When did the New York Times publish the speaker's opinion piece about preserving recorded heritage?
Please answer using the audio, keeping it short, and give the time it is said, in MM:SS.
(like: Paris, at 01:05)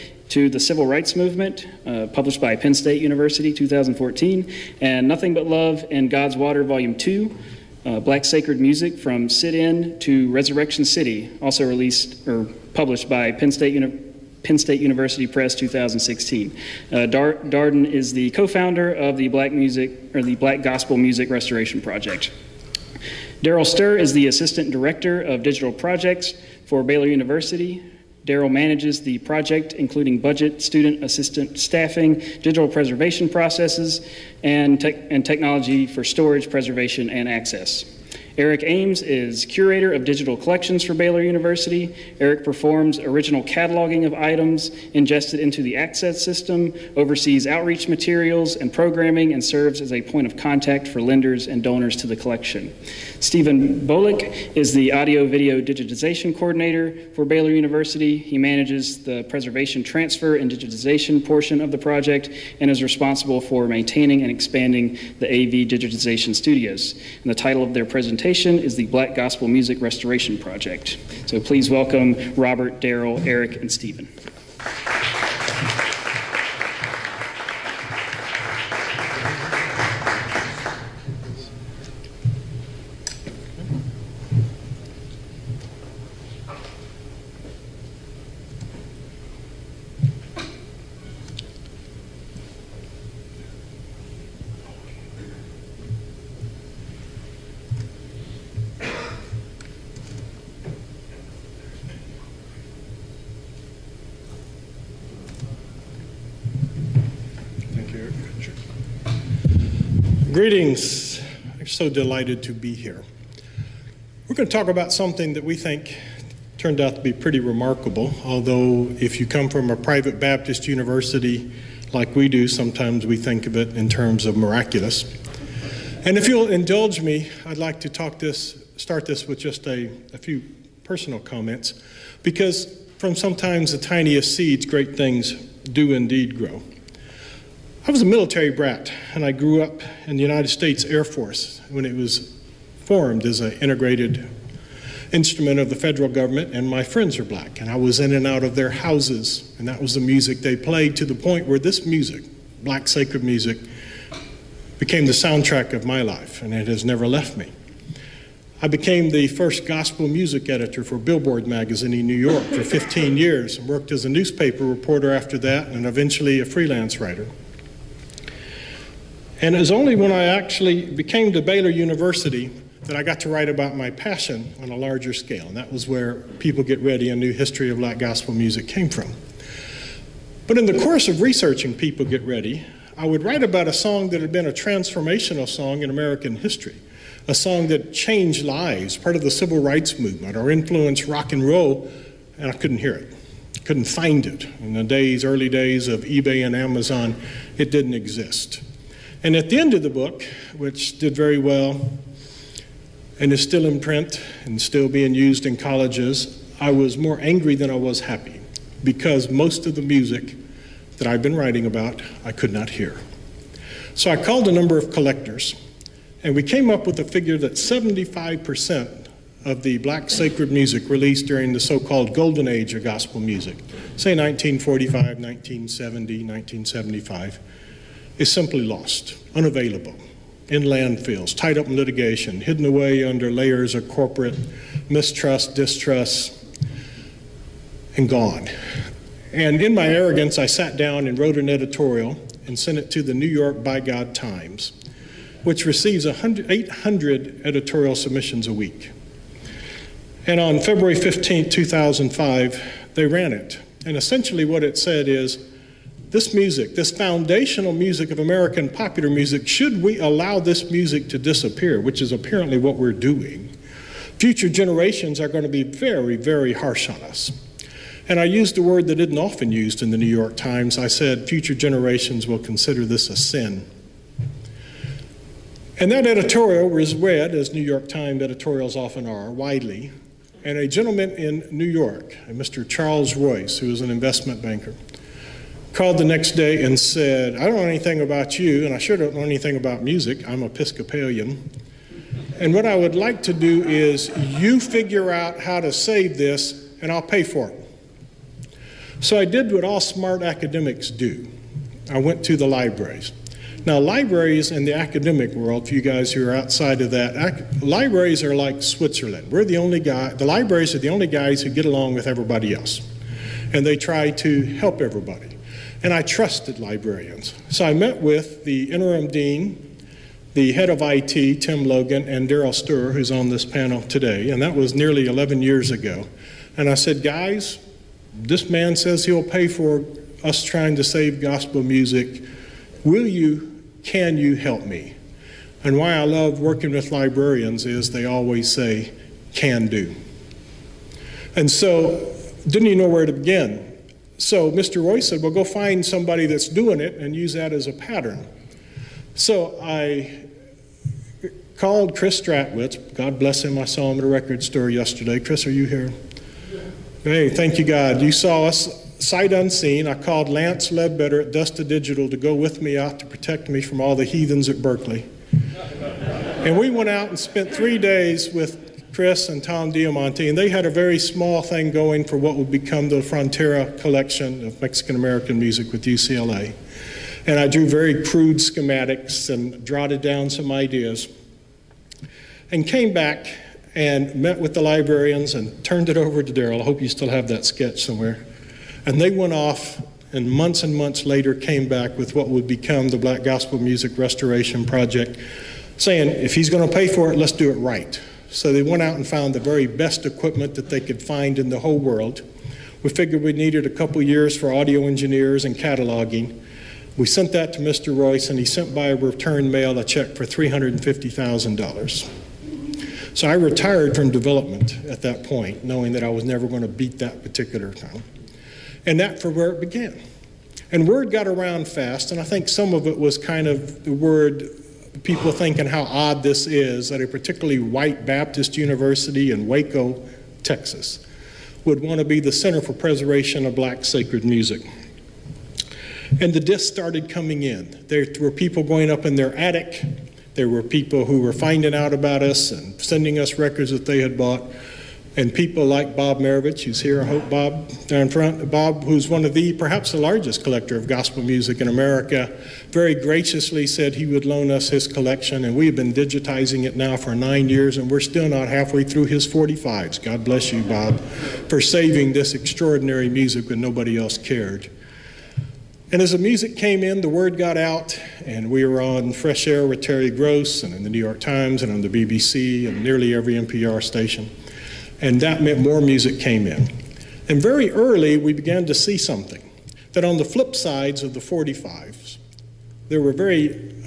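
February 15, 2005, at 04:10.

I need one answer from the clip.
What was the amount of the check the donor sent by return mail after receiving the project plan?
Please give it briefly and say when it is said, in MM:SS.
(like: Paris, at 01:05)
$350,000, at 06:50.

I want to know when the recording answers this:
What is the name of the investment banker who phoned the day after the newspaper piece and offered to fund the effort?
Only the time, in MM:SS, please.
04:42.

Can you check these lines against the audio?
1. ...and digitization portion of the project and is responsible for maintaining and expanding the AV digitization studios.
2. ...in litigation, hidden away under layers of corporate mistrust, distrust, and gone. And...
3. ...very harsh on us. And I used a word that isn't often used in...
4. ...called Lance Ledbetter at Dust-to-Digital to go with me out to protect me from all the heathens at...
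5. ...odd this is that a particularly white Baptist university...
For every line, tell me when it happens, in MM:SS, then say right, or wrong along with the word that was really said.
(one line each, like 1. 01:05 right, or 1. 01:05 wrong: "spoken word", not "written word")
1. 01:00 right
2. 03:51 right
3. 04:26 right
4. 05:59 right
5. 07:05 right.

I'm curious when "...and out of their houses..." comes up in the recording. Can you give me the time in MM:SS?
02:28.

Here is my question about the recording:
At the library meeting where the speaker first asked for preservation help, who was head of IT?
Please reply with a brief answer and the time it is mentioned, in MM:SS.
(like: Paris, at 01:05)
Tim Logan, at 05:21.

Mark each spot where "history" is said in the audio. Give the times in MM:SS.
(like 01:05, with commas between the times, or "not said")
02:57, 03:06.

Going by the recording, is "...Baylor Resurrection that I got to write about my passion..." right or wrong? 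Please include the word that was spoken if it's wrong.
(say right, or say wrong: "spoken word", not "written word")
wrong: "University", not "Resurrection".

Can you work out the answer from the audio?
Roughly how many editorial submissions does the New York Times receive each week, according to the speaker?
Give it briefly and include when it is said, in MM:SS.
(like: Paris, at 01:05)
800, at 04:06.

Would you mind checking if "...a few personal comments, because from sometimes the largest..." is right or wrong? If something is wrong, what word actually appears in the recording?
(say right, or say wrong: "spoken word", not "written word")
wrong: "tiniest", not "largest".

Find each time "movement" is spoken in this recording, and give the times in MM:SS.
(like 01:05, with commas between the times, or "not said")
00:01, 03:09.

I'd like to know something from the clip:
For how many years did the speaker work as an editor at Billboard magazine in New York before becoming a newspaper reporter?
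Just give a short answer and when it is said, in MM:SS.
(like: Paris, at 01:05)
15 years, at 02:42.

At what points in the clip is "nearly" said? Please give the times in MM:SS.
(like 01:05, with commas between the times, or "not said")
05:24, 07:52.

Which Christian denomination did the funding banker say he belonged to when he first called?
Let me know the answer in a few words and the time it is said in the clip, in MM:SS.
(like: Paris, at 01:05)
Episcopalian, at 04:50.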